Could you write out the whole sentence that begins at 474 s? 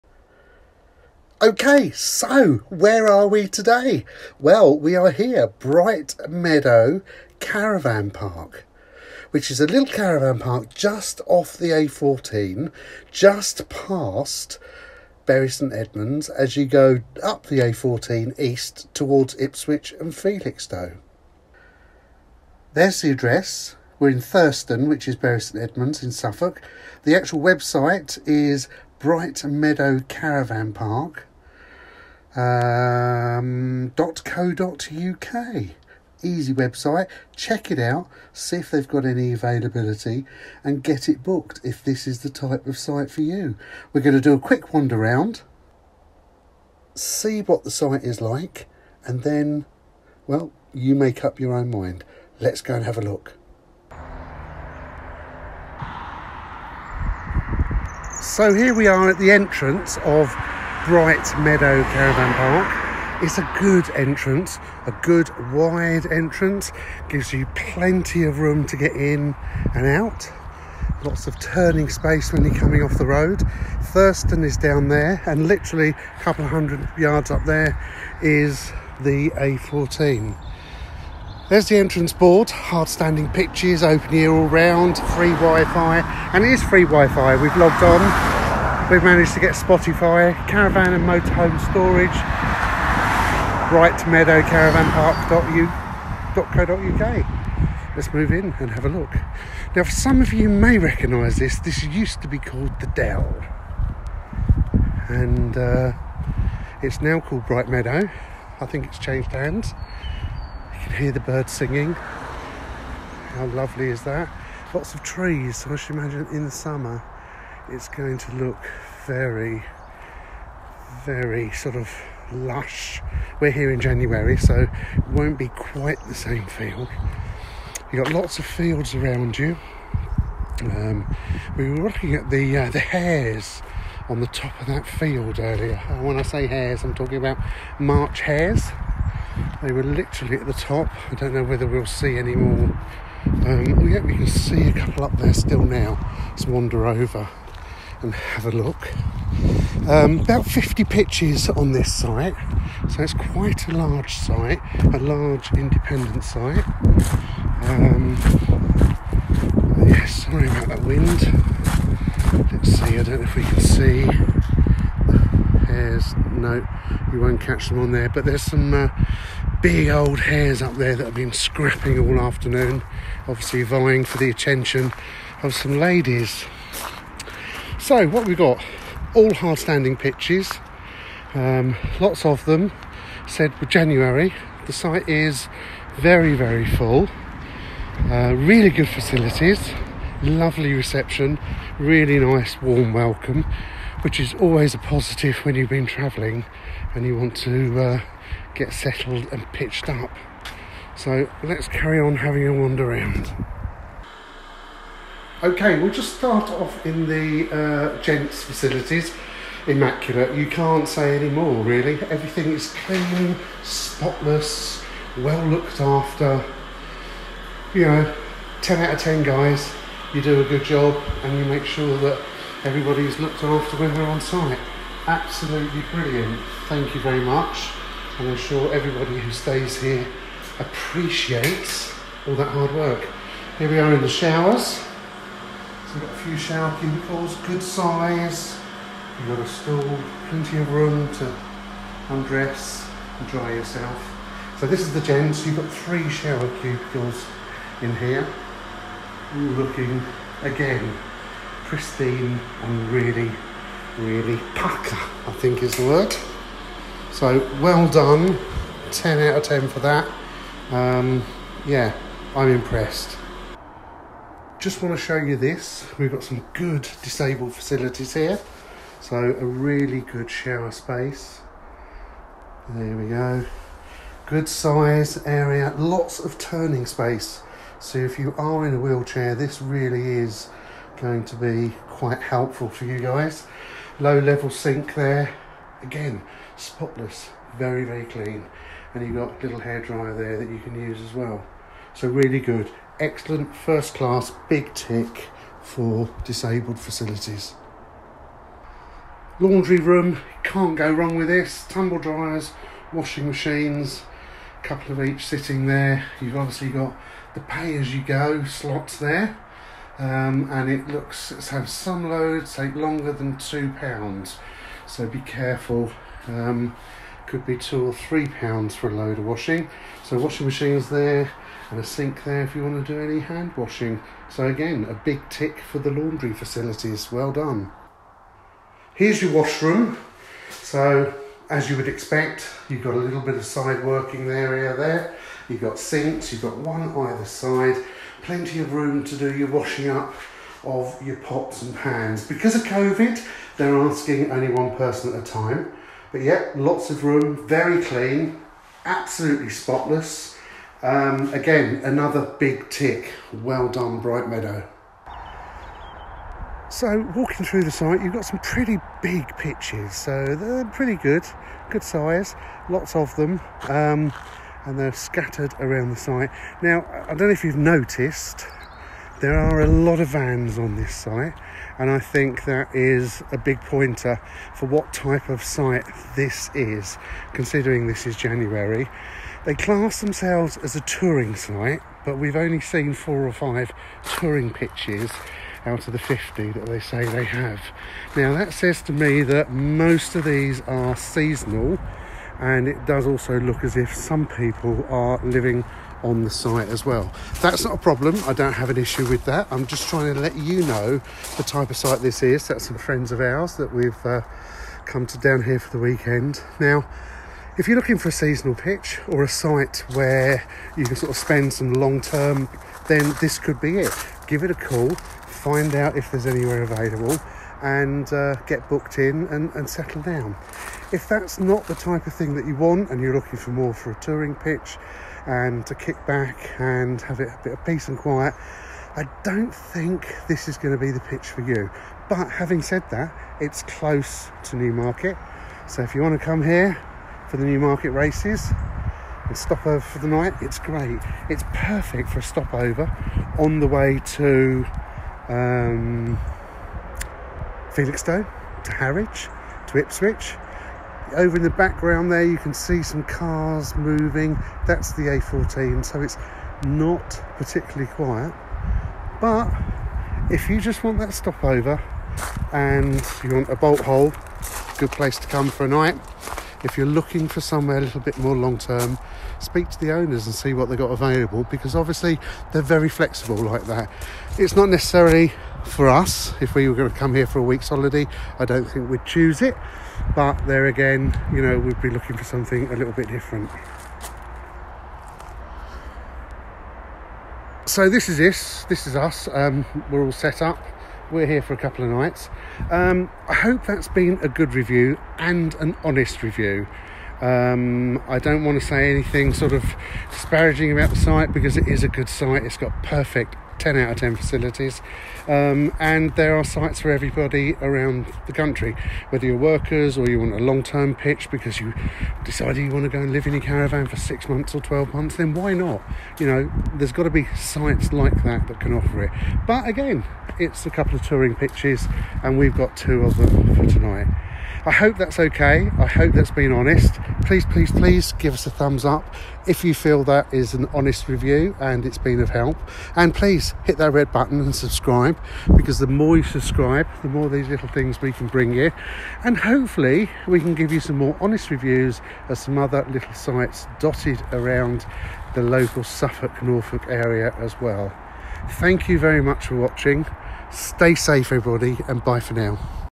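It's not necessarily for us, if we were going to come here for a week's holiday, I don't think we'd choose it.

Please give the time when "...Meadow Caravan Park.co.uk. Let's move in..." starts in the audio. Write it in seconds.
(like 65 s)
94 s.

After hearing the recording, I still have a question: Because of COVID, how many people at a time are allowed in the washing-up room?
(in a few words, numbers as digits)
1.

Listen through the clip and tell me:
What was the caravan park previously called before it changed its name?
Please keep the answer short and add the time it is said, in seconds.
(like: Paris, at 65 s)
The Dell, at 102 s.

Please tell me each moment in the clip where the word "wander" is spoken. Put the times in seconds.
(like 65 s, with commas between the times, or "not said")
44 s, 146 s, 202 s.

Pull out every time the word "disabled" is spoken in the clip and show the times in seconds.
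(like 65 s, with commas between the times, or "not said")
267 s, 296 s.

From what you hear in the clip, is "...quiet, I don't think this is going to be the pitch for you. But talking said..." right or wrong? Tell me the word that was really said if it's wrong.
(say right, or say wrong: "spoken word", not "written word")
wrong: "having", not "talking".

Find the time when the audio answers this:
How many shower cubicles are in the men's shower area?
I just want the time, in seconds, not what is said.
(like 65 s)
245 s.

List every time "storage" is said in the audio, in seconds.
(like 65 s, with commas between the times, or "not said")
91 s.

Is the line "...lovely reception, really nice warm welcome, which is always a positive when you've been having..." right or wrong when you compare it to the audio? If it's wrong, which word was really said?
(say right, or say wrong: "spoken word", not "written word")
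wrong: "travelling", not "having".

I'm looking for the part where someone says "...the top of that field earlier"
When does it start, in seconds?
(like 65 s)
134 s.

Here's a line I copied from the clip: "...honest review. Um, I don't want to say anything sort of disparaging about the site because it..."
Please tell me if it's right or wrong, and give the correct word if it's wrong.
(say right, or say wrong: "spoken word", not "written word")
right.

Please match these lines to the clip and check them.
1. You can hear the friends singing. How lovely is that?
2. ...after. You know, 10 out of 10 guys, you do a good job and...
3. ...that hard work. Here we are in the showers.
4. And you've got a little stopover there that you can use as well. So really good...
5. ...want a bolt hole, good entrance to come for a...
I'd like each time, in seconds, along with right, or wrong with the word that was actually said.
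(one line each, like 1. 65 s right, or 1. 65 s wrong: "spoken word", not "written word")
1. 110 s wrong: "birds", not "friends"
2. 215 s right
3. 232 s right
4. 288 s wrong: "hairdryer", not "stopover"
5. 463 s wrong: "place", not "entrance".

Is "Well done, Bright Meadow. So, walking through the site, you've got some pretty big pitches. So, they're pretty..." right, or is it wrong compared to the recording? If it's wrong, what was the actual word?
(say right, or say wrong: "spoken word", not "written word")
right.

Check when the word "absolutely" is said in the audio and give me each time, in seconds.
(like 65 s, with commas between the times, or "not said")
225 s, 348 s.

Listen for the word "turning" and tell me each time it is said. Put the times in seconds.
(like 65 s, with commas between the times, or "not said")
71 s, 276 s.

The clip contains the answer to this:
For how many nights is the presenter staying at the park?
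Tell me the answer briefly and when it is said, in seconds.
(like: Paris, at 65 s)
2, at 491 s.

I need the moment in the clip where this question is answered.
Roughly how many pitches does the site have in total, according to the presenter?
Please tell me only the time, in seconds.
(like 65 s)
150 s.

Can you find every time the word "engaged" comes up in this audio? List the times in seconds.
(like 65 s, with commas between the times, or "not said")
not said.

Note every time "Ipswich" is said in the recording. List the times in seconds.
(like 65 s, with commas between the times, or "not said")
19 s, 449 s.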